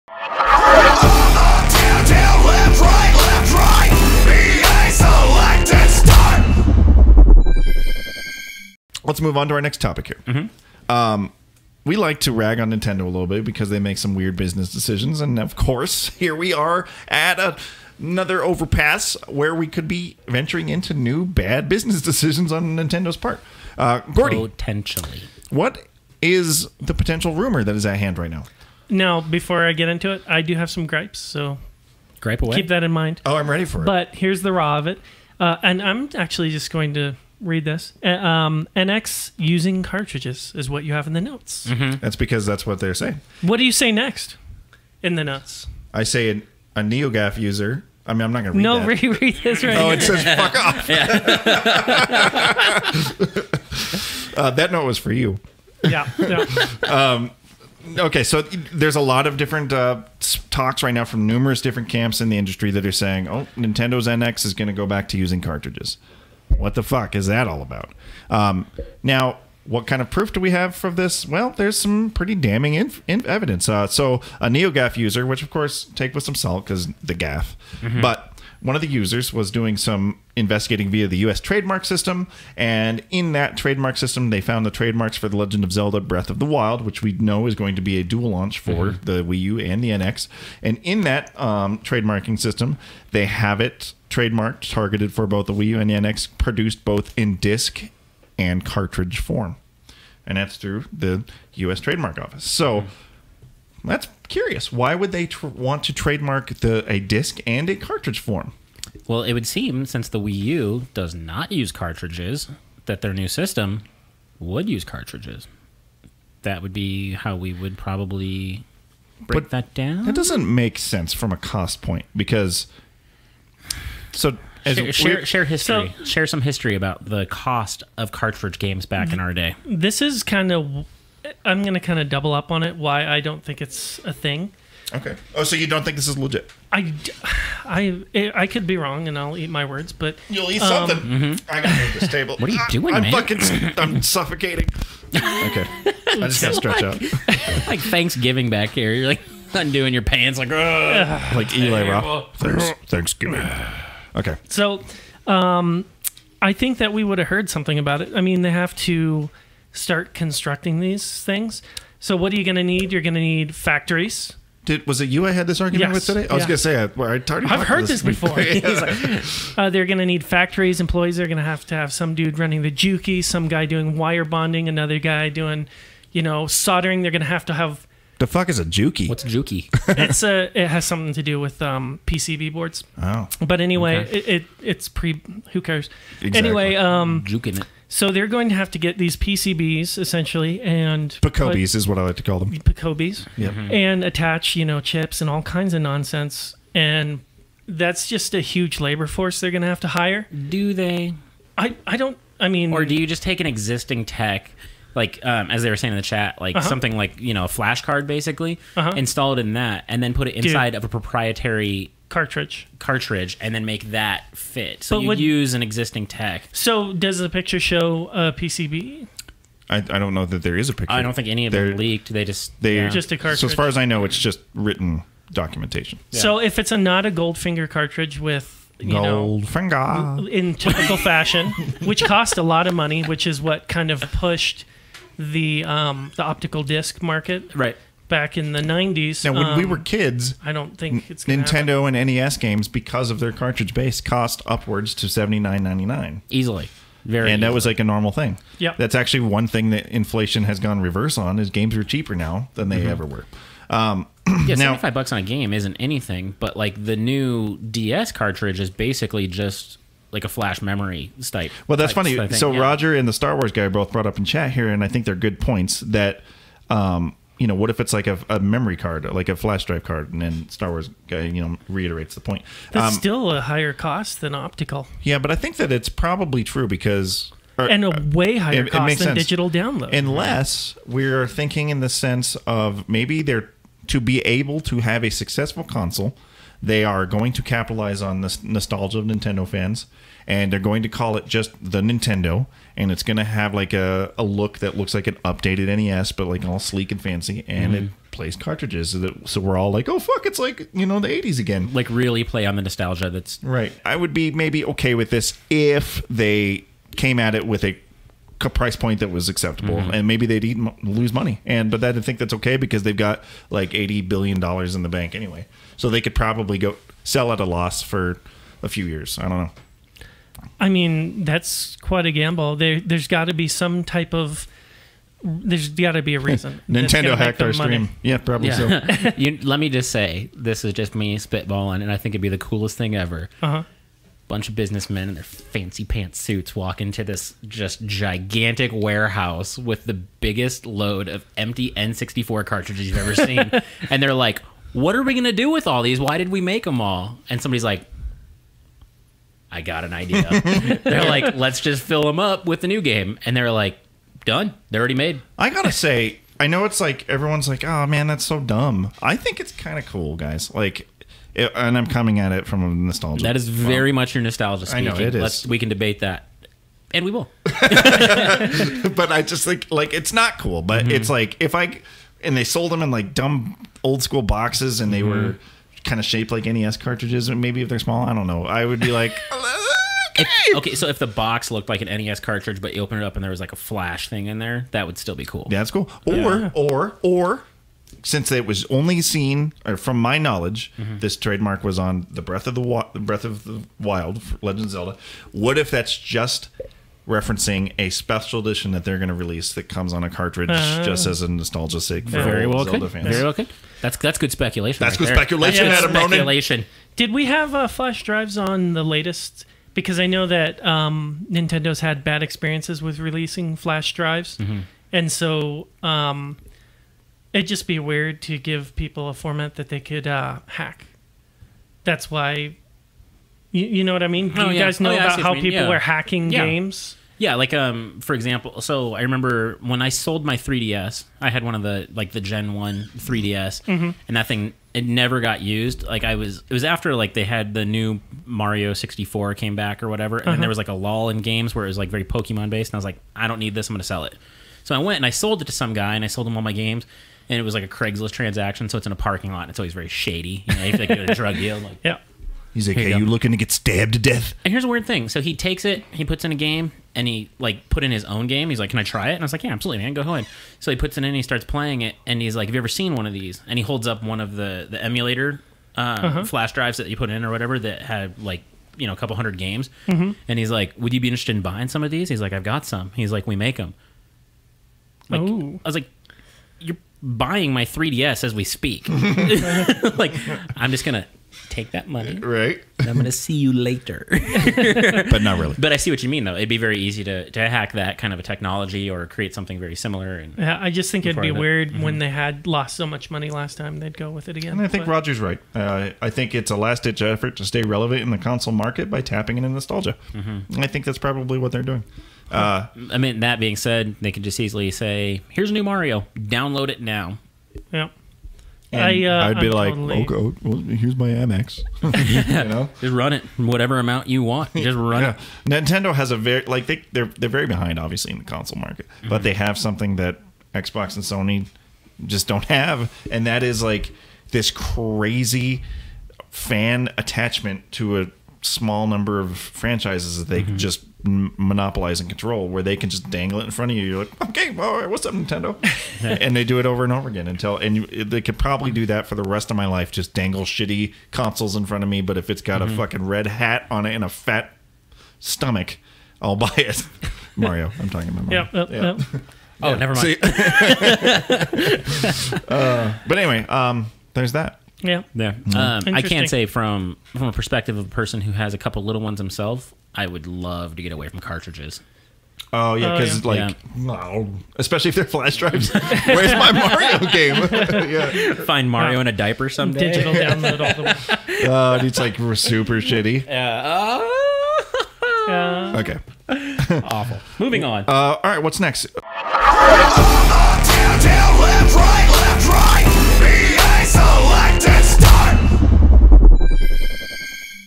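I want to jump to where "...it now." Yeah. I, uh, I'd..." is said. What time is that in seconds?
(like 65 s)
506 s.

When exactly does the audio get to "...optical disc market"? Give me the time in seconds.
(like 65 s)
236 s.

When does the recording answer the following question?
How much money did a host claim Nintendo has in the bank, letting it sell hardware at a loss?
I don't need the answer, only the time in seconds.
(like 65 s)
313 s.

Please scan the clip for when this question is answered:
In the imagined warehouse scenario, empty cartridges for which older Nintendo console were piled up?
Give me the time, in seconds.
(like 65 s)
341 s.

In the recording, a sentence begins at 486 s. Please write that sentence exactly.
It'd be very easy to, to hack that kind of a technology or create something very similar.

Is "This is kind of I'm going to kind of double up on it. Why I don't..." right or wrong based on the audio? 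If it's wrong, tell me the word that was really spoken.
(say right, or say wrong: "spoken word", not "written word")
right.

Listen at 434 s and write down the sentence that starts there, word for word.
and that thing it never got used.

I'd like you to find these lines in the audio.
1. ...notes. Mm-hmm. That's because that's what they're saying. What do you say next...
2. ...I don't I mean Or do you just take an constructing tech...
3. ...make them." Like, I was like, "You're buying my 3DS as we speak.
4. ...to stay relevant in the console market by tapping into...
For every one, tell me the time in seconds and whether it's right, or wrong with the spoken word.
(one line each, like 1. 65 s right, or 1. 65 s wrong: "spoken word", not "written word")
1. 41 s right
2. 201 s wrong: "existing", not "constructing"
3. 473 s right
4. 497 s right.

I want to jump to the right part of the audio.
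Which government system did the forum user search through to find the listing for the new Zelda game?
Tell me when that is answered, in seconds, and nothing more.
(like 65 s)
81 s.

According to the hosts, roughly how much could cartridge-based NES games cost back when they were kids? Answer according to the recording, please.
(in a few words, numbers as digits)
$79.99.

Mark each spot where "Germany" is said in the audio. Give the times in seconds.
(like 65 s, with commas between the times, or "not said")
not said.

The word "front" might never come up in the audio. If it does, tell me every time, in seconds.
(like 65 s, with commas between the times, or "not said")
533 s, 541 s.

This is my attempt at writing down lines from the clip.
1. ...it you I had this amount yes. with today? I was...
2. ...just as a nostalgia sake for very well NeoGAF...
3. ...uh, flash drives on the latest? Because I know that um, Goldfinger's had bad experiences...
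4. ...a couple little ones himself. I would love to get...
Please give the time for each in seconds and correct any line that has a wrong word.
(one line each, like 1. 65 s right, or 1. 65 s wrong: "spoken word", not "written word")
1. 165 s wrong: "argument", not "amount"
2. 400 s wrong: "Zelda", not "NeoGAF"
3. 407 s wrong: "Nintendo", not "Goldfinger"
4. 558 s right.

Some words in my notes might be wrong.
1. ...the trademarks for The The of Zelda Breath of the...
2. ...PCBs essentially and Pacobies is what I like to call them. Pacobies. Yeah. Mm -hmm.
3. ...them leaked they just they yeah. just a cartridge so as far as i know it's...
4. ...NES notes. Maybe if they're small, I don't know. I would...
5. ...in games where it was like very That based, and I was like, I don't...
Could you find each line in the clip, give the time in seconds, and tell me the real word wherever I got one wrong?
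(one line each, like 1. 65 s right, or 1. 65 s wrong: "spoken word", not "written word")
1. 84 s wrong: "Legend", not "The"
2. 189 s right
3. 221 s right
4. 376 s wrong: "cartridges", not "notes"
5. 441 s wrong: "Pokemon", not "That".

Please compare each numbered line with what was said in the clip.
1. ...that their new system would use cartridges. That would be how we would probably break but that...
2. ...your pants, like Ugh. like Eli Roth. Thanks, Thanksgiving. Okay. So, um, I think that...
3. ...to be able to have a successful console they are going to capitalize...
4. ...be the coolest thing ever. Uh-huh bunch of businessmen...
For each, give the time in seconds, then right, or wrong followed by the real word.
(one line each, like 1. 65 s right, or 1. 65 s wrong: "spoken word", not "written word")
1. 112 s right
2. 149 s right
3. 283 s right
4. 332 s right.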